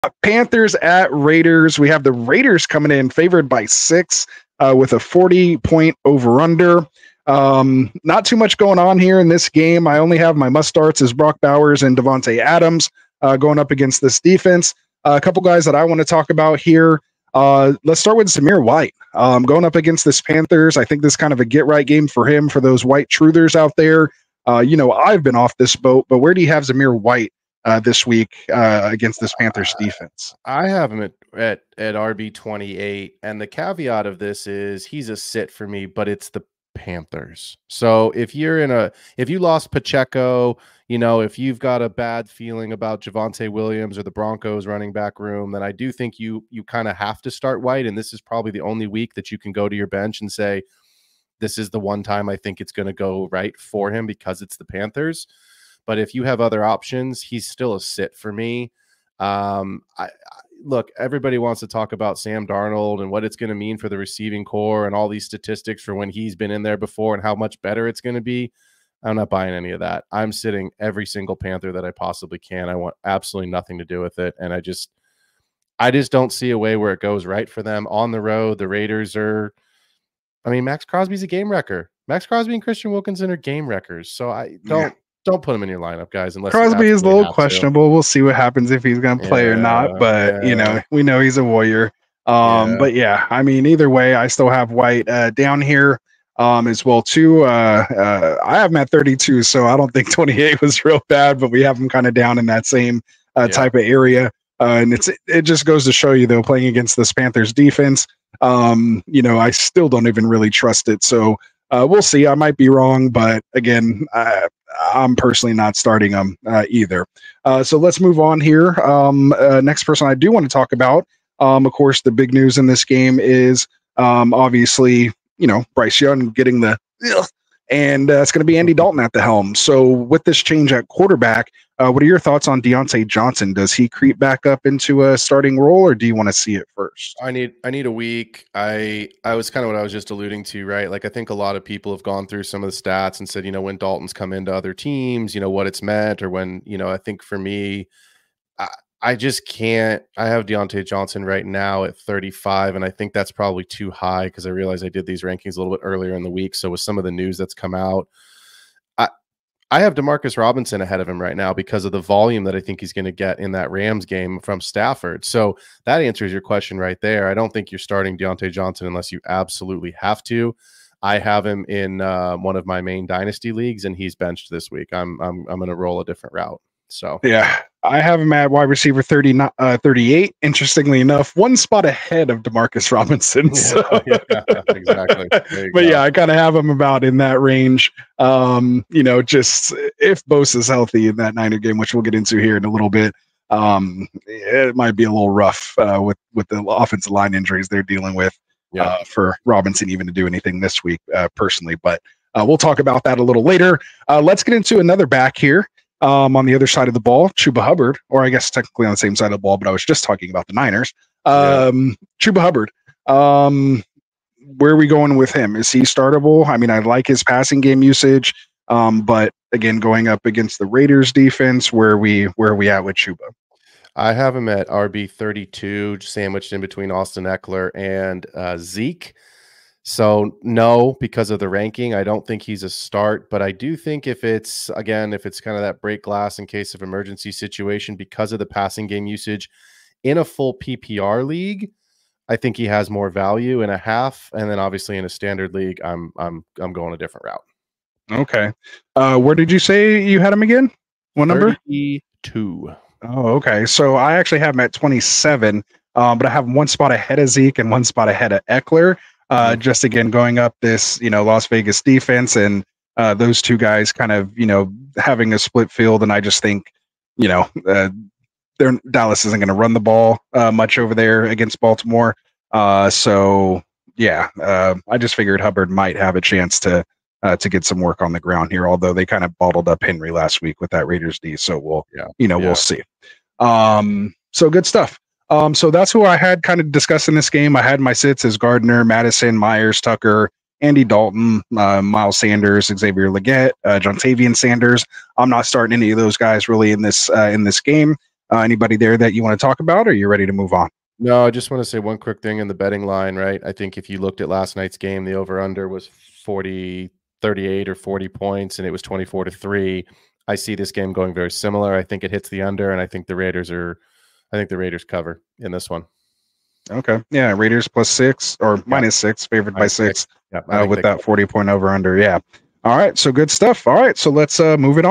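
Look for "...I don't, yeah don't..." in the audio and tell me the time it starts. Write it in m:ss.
1:24.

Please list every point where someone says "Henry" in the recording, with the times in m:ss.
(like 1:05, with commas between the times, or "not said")
4:39.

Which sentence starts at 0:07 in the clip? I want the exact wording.
Um, not too much going on here in this game.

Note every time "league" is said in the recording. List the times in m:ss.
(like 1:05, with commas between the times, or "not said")
2:53, 4:01, 4:05.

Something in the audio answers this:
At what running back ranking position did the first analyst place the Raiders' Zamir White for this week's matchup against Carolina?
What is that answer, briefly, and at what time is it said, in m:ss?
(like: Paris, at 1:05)
RB28, at 0:31.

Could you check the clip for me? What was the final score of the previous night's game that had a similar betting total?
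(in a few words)
24 to 3.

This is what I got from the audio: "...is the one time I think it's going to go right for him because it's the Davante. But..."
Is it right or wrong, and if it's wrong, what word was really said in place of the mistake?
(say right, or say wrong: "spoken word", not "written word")
wrong: "Panthers", not "Davante".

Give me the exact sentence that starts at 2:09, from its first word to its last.
So, with this change at quarterback, uh, what are your thoughts on Diontae Johnson?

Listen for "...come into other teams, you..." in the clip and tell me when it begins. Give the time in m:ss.
2:24.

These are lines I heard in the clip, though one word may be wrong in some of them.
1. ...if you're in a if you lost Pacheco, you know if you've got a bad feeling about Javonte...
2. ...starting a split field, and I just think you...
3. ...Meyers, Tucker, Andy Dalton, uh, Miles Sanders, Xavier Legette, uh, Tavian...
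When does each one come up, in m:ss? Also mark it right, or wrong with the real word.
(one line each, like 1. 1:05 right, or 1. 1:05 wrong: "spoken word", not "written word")
1. 0:38 right
2. 4:24 wrong: "having", not "starting"
3. 4:49 right.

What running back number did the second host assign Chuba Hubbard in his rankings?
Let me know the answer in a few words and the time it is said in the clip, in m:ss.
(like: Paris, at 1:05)
27, at 4:14.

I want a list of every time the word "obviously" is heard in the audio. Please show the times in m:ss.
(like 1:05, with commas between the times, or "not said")
2:04, 4:04.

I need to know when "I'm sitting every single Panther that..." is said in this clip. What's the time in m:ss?
1:10.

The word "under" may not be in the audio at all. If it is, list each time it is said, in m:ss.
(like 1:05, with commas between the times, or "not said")
0:06, 5:05, 5:12, 5:21.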